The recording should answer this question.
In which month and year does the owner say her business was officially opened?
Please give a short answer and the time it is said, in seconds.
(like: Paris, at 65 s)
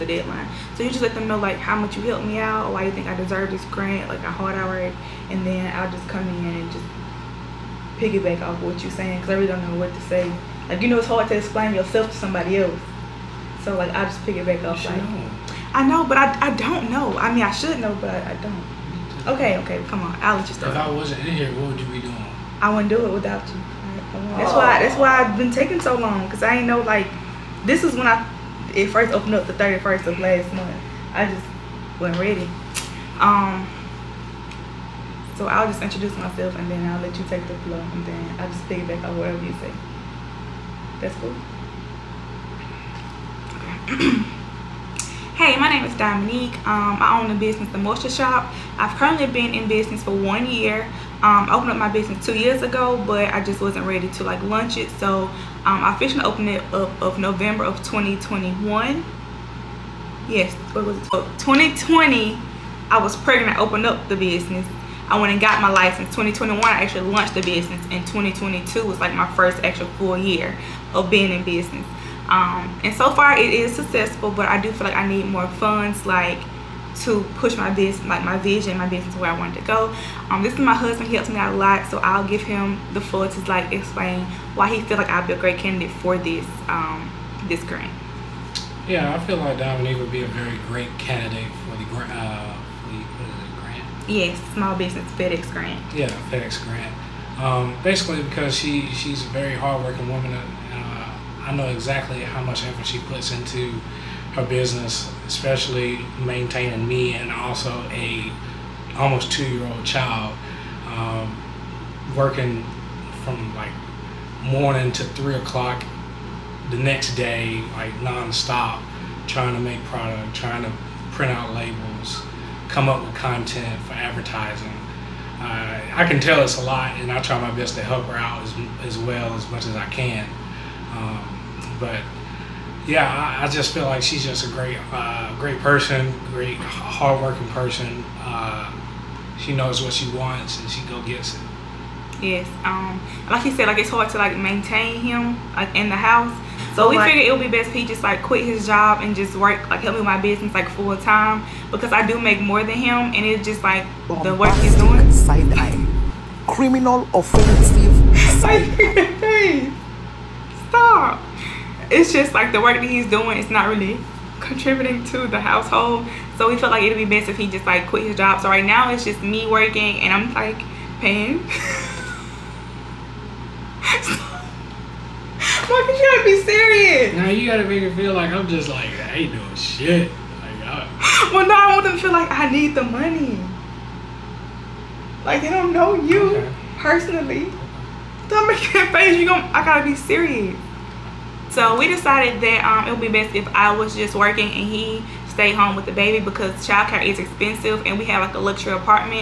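November 2021, at 57 s.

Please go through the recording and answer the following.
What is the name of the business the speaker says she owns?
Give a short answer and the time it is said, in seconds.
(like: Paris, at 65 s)
The Moisture Shop, at 47 s.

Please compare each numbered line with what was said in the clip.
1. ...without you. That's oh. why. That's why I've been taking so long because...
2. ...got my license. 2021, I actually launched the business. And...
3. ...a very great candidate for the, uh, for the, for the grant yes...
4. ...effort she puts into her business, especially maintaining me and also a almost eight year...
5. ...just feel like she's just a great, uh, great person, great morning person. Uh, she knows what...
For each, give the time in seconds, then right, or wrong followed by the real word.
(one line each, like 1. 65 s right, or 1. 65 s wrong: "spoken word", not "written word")
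1. 23 s right
2. 65 s right
3. 90 s right
4. 102 s wrong: "two", not "eight"
5. 133 s wrong: "hardworking", not "morning".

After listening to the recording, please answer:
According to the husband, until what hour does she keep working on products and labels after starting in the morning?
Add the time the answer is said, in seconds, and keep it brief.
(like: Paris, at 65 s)
3 o'clock, at 115 s.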